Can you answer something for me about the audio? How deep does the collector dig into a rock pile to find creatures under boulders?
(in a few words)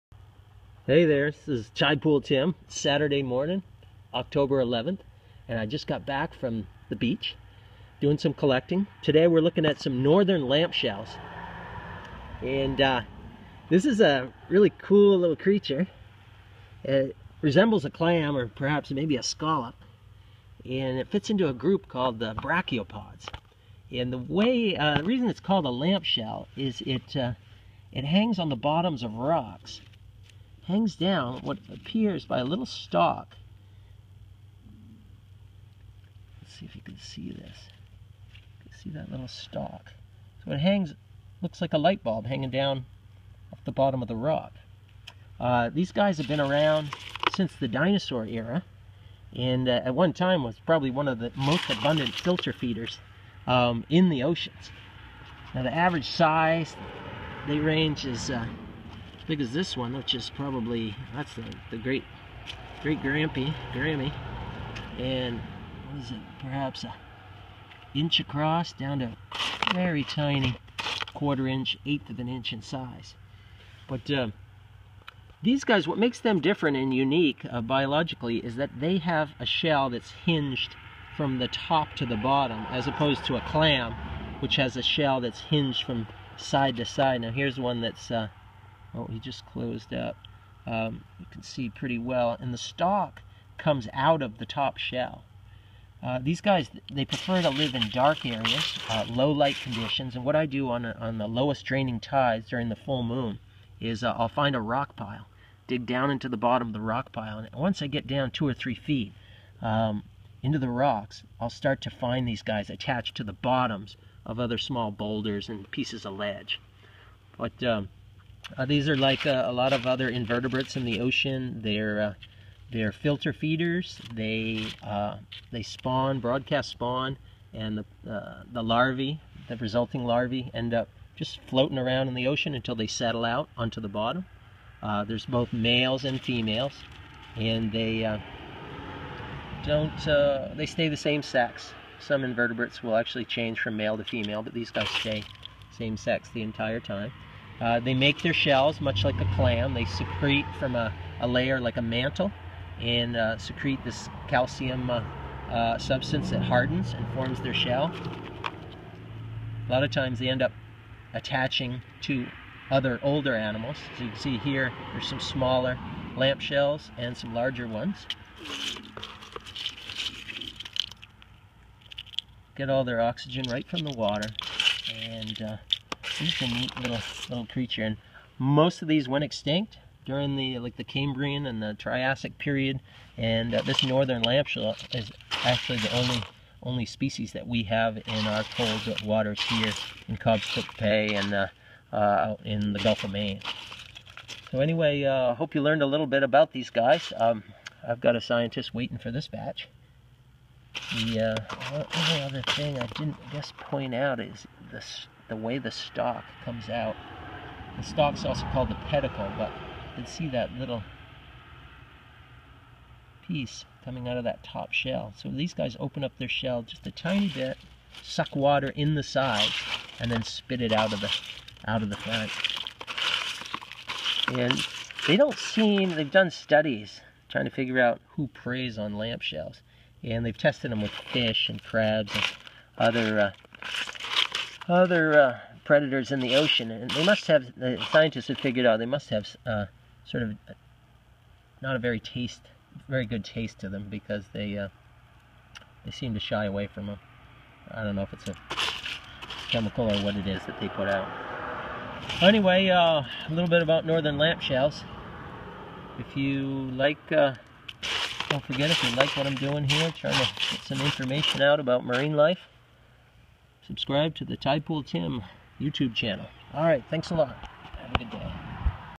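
2 or 3 feet.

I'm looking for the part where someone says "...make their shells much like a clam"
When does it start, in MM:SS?
02:27.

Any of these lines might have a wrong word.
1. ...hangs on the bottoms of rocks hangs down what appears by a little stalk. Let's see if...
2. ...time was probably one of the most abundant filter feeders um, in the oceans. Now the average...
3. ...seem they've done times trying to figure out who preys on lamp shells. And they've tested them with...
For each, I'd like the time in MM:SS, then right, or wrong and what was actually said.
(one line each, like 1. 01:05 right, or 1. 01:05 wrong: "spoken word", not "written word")
1. 00:28 right
2. 00:50 right
3. 03:45 wrong: "studies", not "times".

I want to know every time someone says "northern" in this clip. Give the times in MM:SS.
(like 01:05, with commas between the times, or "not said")
00:10, 03:03, 04:13.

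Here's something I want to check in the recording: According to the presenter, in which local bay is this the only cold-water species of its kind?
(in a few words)
Cobscook Bay.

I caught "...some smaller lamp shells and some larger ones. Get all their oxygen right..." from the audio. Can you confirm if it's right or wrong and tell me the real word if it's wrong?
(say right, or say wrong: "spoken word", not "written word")
right.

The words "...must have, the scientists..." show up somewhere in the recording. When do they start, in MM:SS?
03:57.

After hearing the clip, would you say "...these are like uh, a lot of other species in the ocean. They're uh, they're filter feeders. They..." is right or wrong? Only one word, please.
wrong.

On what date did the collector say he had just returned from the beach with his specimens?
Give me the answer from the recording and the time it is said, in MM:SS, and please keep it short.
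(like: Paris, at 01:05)
October 11th, at 00:04.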